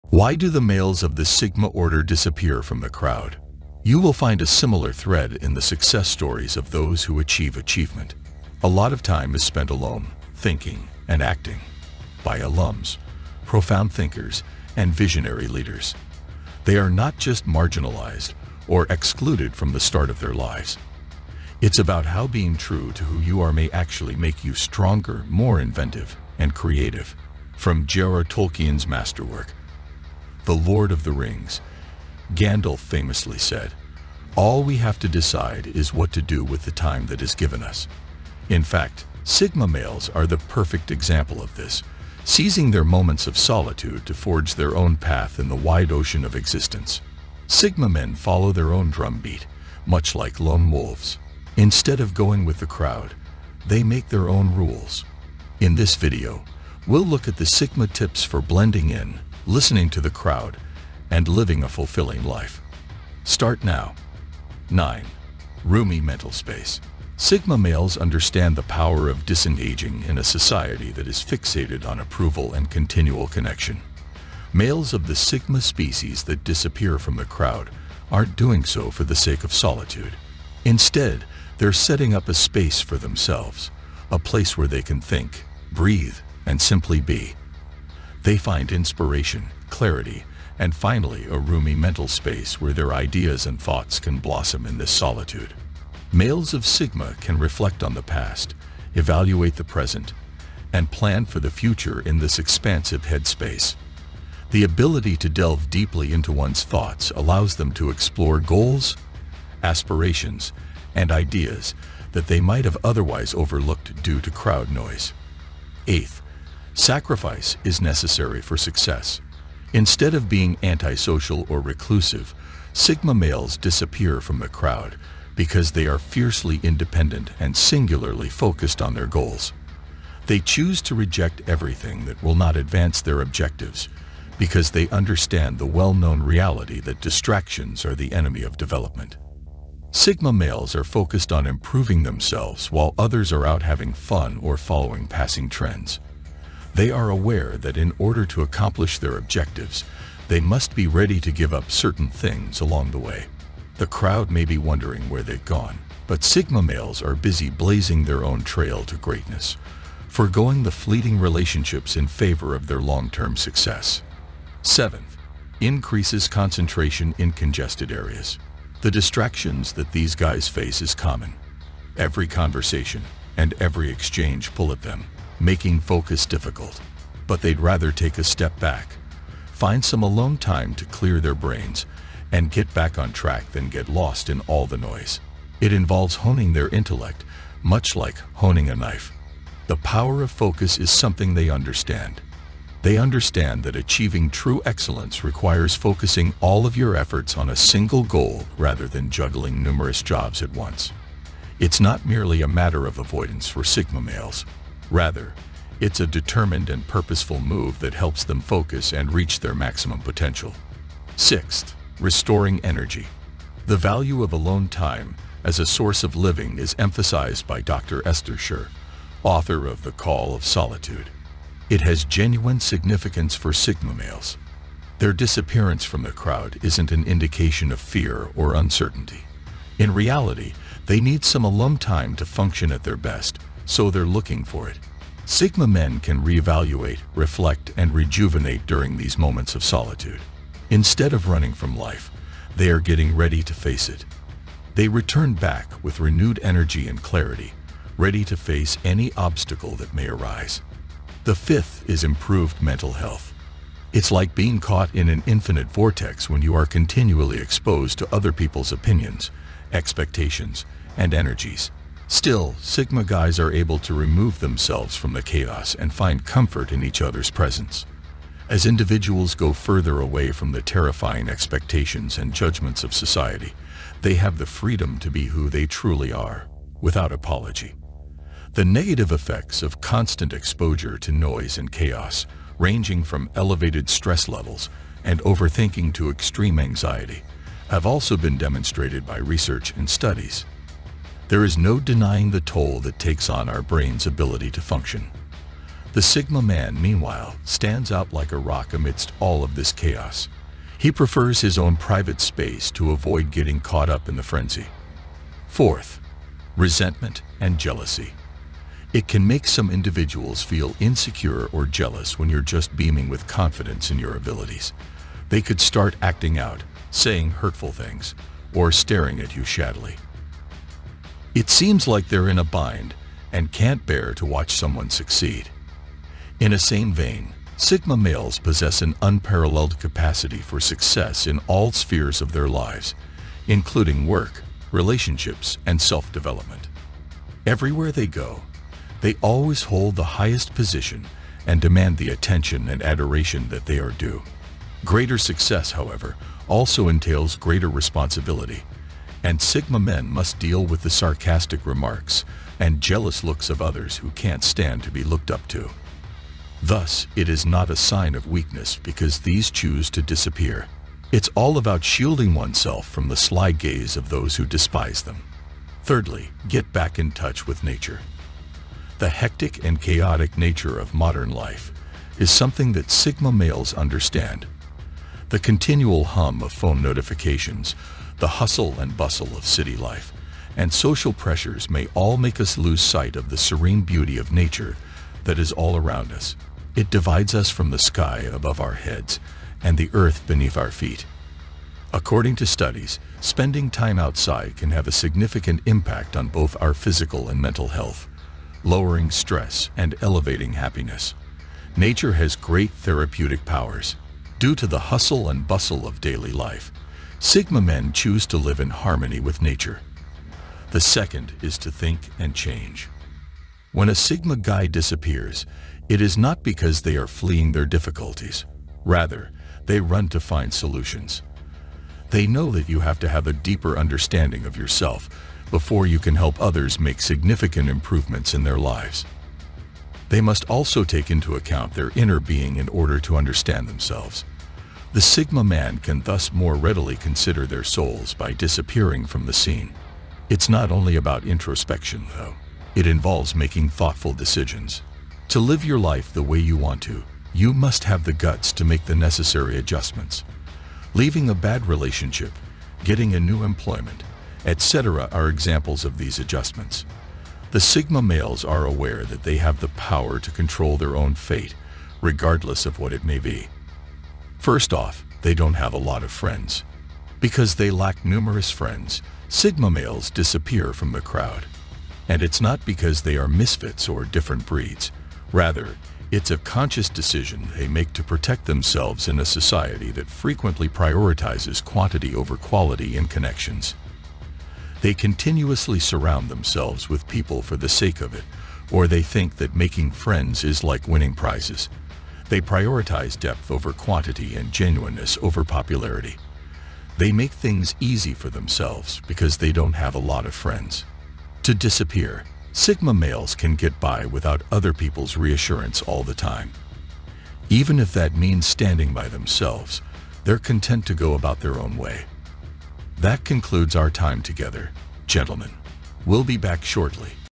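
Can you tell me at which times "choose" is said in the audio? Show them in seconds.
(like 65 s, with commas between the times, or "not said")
130 s, 359 s, 407 s.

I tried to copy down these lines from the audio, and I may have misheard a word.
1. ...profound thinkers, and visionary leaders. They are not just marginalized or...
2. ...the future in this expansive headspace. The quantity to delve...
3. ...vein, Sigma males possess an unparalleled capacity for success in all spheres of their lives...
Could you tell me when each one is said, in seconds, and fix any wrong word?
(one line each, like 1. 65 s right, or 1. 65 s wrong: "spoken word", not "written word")
1. 13 s right
2. 101 s wrong: "ability", not "quantity"
3. 326 s right.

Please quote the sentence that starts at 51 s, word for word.
Instead of going with the crowd, they make their own rules.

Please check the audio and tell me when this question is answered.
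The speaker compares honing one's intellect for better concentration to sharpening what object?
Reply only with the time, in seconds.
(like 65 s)
188 s.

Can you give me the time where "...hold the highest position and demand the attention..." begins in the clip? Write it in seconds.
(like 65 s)
339 s.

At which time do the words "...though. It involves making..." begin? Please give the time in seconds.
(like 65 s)
442 s.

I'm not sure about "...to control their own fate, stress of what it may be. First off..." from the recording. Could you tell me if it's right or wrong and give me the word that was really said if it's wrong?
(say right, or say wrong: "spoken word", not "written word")
wrong: "regardless", not "stress".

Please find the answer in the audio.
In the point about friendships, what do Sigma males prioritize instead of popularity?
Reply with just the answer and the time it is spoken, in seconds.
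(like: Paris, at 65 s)
Genuineness, at 494 s.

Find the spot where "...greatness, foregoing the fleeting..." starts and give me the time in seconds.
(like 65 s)
158 s.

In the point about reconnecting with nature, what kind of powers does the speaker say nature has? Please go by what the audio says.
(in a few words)
Therapeutic.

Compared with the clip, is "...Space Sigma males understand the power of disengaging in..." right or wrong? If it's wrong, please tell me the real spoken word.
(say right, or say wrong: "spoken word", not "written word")
right.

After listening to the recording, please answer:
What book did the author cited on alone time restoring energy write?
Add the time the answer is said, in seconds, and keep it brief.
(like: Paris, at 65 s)
The Call of Solitude, at 219 s.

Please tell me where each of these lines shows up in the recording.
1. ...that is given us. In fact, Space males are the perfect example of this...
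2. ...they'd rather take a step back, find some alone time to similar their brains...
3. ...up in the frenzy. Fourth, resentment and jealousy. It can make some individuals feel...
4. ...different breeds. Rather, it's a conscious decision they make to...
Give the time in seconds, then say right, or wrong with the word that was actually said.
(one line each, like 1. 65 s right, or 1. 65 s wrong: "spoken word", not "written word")
1. 37 s wrong: "Sigma", not "Space"
2. 177 s wrong: "clear", not "similar"
3. 303 s right
4. 474 s right.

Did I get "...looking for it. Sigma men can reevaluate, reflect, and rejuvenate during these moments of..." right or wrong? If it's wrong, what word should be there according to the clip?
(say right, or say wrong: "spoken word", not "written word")
right.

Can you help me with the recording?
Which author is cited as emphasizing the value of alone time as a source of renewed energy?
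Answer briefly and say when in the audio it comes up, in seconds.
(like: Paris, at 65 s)
Dr. Esther Scher, at 217 s.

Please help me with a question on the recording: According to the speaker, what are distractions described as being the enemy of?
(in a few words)
Development.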